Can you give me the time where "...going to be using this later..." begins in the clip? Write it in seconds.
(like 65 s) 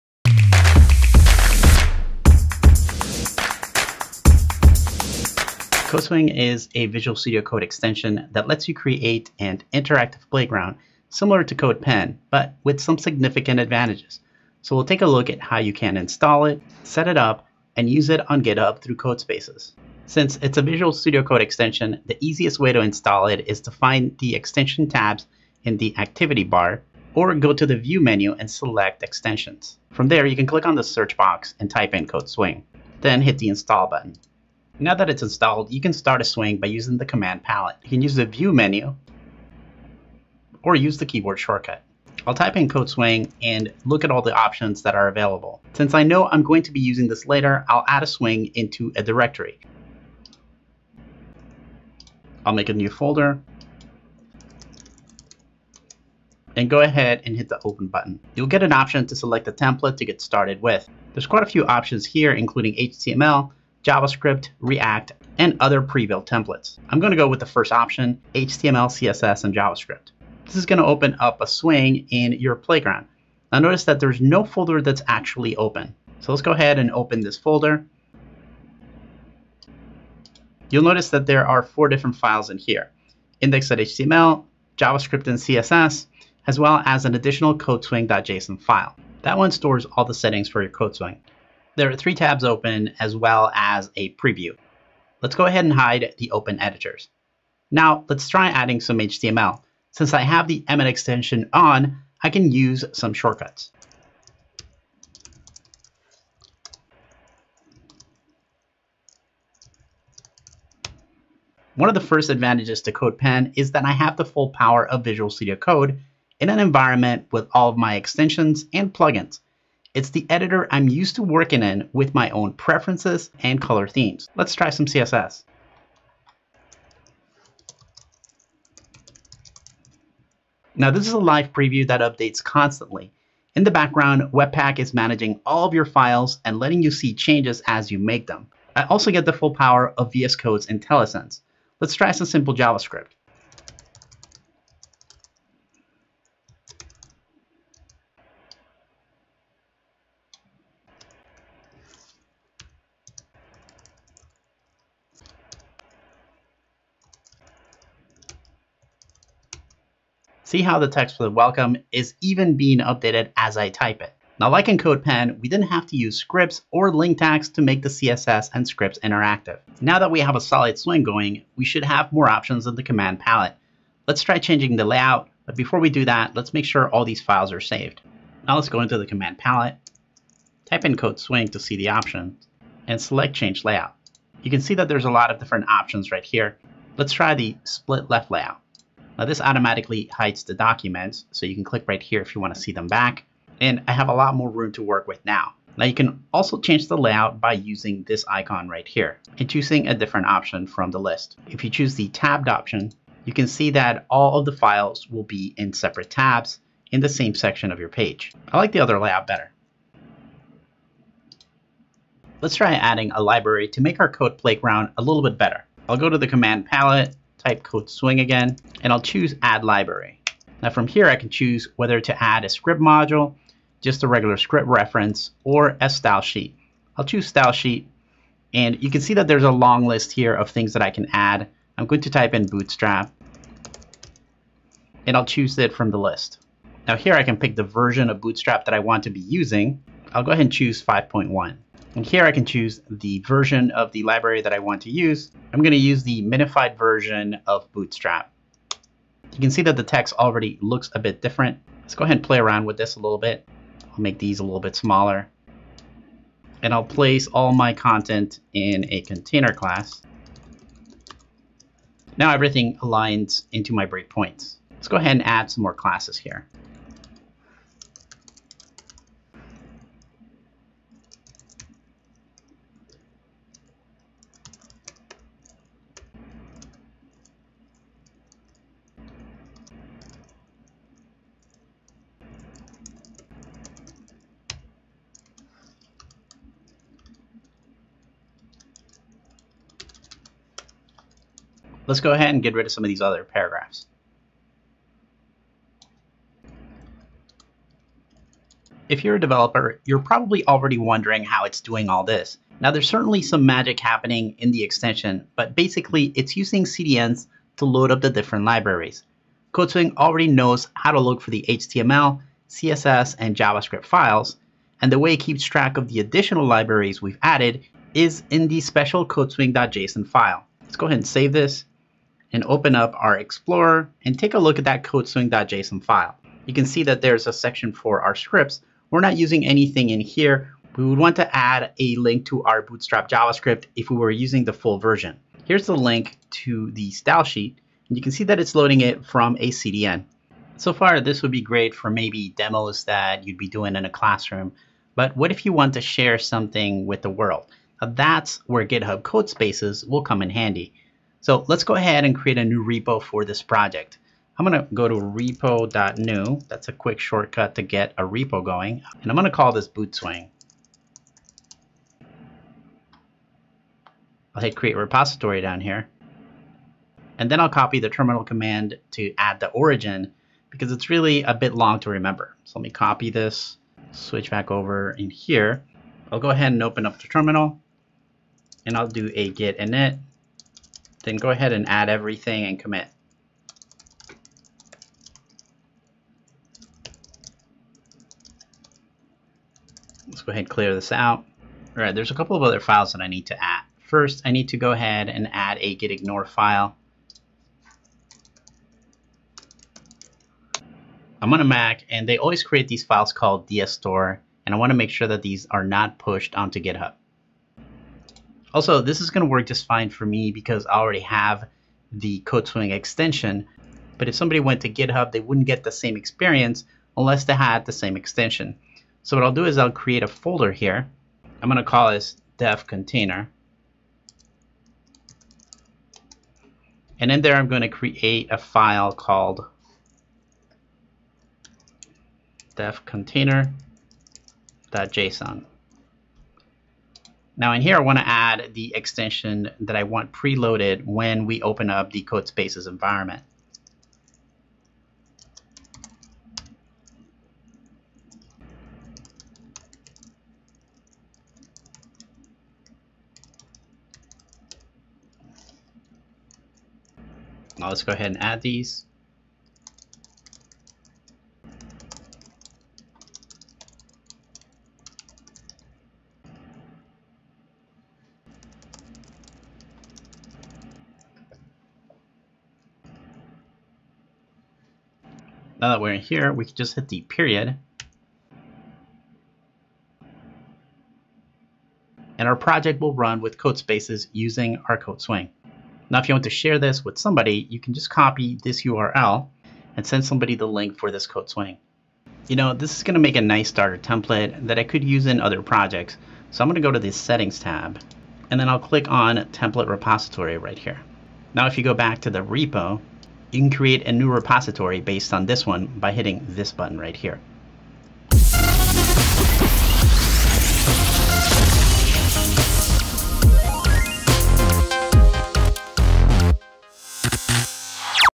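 46 s.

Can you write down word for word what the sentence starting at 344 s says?
But what if you want to share something with the world?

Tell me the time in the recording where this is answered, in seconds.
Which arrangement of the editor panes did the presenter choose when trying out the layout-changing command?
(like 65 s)
187 s.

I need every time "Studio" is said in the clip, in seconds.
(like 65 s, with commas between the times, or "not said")
7 s, 20 s, 115 s.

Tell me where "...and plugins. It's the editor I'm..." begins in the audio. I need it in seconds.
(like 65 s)
118 s.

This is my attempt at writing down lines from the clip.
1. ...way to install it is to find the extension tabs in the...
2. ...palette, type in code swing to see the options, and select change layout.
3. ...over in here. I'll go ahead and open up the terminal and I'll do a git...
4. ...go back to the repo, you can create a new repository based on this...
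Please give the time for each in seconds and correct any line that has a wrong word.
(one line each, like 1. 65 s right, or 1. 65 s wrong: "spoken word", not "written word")
1. 22 s right
2. 179 s right
3. 374 s right
4. 501 s right.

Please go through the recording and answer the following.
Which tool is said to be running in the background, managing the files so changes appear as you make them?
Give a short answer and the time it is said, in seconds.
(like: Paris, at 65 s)
Webpack, at 134 s.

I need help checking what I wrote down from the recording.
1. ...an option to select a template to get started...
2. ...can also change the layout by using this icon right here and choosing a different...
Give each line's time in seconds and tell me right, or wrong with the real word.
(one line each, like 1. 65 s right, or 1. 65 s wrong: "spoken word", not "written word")
1. 58 s right
2. 195 s right.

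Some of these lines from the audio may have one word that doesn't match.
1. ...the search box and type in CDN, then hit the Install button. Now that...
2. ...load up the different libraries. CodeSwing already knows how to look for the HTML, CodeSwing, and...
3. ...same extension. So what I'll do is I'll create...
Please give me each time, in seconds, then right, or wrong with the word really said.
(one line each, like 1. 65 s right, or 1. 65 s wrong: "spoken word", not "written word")
1. 30 s wrong: "CodeSwing", not "CDN"
2. 307 s wrong: "CSS", not "CodeSwing"
3. 417 s right.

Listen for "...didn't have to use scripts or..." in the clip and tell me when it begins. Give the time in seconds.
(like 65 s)
165 s.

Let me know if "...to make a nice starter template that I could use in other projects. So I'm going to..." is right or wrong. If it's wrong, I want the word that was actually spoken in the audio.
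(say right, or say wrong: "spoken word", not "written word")
right.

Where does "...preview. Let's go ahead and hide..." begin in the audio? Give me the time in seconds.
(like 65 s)
94 s.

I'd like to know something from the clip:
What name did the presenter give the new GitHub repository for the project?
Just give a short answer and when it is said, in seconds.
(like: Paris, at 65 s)
bootswing, at 359 s.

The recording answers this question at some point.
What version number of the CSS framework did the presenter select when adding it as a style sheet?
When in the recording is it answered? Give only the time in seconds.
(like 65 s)
240 s.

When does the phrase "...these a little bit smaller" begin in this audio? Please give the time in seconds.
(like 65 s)
254 s.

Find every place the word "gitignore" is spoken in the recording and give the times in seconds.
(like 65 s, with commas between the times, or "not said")
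395 s.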